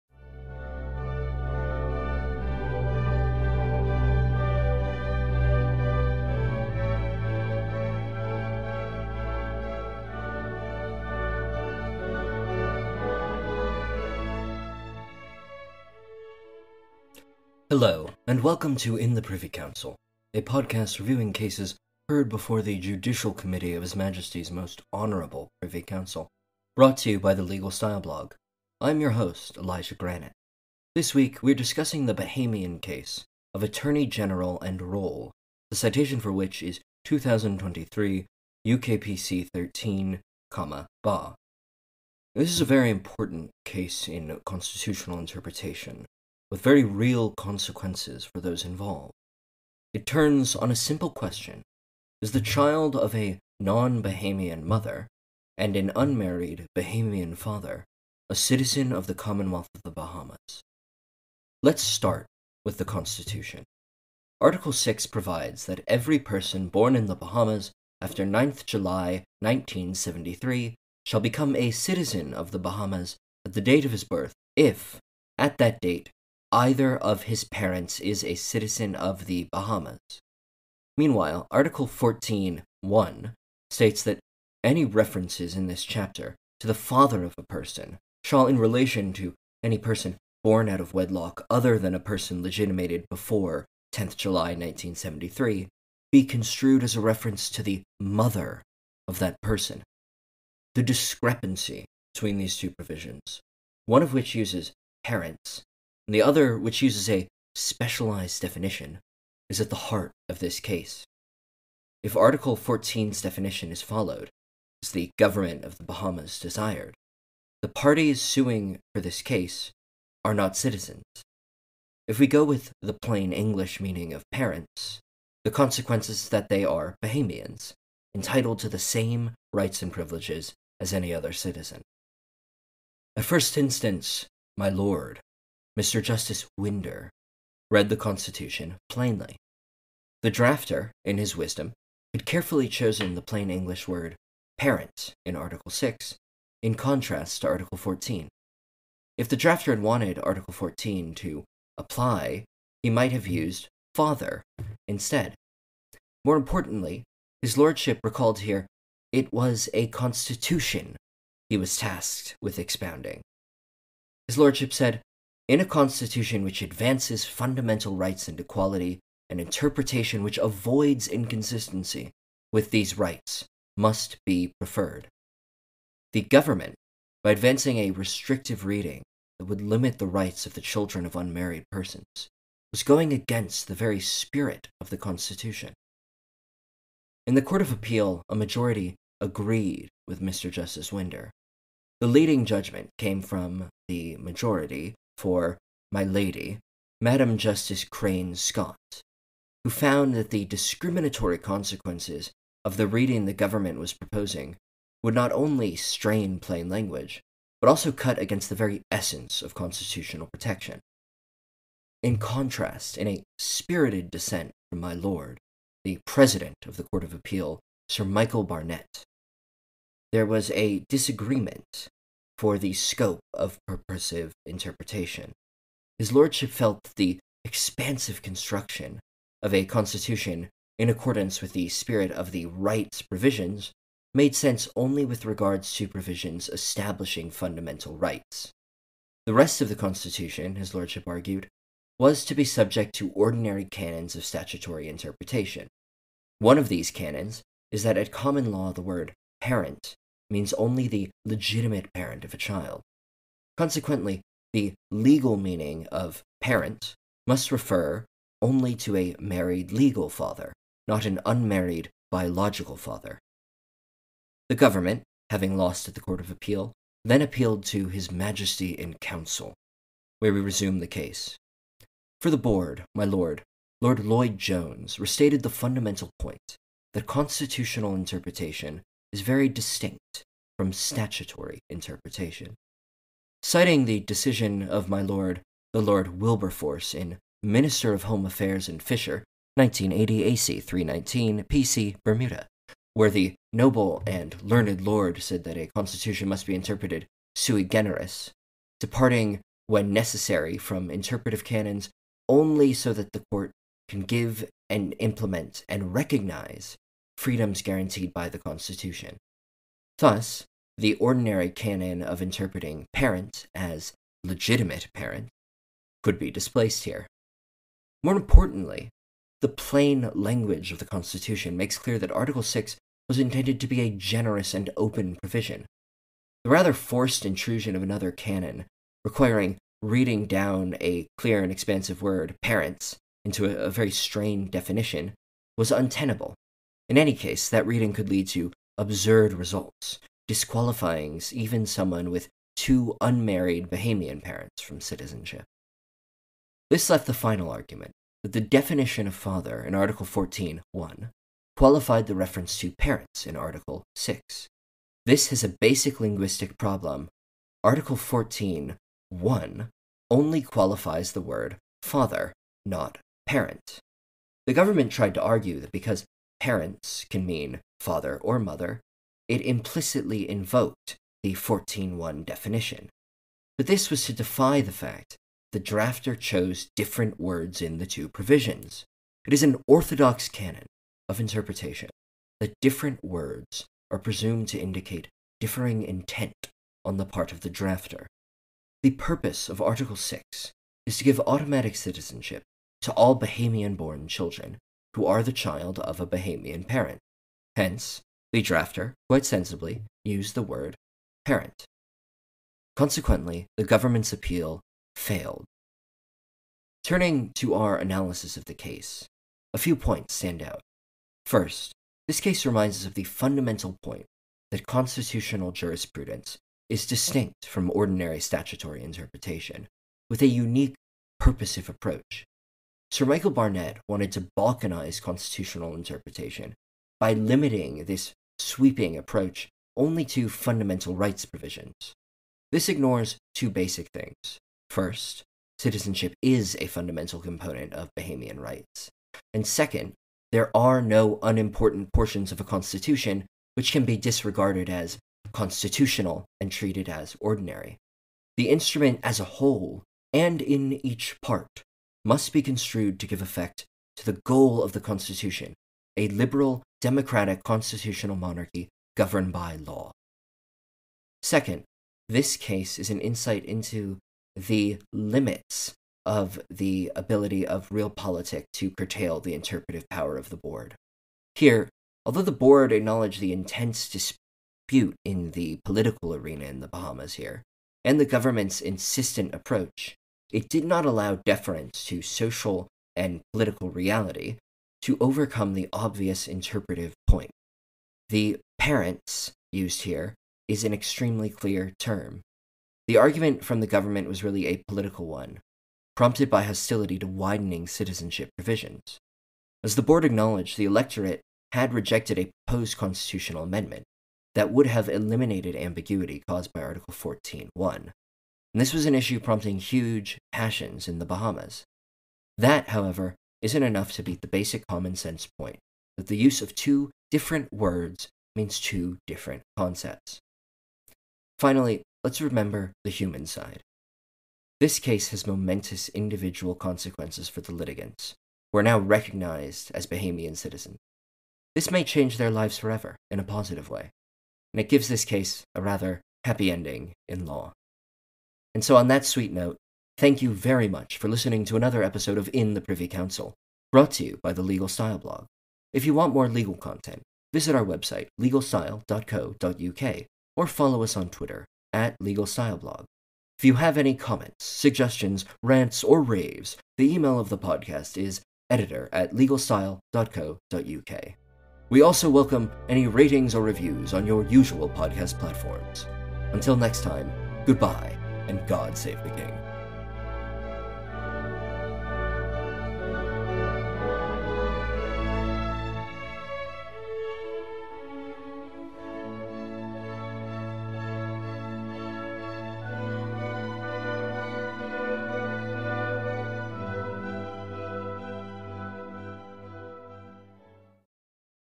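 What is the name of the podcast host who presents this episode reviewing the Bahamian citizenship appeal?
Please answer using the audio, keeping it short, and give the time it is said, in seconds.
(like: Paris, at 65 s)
Elijah Granite, at 29 s.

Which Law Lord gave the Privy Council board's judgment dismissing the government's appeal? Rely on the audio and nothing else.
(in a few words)
Lord Lloyd Jones.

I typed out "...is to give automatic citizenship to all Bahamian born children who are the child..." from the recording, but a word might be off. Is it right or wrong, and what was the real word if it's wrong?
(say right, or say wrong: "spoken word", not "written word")
right.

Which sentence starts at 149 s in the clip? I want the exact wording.
If the drafter had wanted Article 14 to apply, he might have used father instead.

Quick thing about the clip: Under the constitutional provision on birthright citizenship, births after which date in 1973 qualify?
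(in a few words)
9th July 1973.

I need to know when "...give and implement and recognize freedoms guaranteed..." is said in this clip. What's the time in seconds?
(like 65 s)
304 s.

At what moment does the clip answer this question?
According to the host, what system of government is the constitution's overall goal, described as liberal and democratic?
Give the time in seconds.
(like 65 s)
457 s.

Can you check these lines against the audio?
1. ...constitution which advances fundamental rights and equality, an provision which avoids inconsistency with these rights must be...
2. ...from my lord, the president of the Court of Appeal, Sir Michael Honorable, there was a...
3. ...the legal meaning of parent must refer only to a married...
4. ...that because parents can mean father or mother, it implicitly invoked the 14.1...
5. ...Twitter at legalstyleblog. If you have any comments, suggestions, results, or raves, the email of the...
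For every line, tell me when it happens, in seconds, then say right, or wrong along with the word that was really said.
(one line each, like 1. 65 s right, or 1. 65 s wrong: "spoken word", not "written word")
1. 165 s wrong: "interpretation", not "provision"
2. 214 s wrong: "Barnett", not "Honorable"
3. 254 s right
4. 365 s right
5. 551 s wrong: "rants", not "results".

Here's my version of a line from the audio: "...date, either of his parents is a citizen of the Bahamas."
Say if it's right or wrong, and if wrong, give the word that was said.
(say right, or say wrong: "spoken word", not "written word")
right.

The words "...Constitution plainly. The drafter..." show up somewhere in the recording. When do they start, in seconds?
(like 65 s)
137 s.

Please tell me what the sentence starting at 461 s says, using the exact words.
Second, this case is an insight into the limits of the ability of realpolitik to curtail the interpretive power of the board.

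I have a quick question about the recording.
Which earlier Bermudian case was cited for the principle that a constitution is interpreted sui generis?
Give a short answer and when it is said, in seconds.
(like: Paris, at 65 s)
Minister of Home Affairs and Fisher, at 287 s.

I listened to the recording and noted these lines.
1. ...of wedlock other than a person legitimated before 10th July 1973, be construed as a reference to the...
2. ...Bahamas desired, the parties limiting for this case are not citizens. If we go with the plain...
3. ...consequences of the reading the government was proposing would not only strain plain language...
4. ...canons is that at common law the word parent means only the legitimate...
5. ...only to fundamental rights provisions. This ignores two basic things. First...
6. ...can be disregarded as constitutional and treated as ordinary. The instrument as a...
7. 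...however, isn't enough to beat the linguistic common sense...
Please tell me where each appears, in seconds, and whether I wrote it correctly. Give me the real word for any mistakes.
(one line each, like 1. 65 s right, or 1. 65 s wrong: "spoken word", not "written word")
1. 90 s right
2. 115 s wrong: "suing", not "limiting"
3. 201 s right
4. 246 s right
5. 429 s right
6. 443 s right
7. 512 s wrong: "basic", not "linguistic".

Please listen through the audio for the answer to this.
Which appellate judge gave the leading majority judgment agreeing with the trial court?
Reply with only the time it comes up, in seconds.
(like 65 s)
196 s.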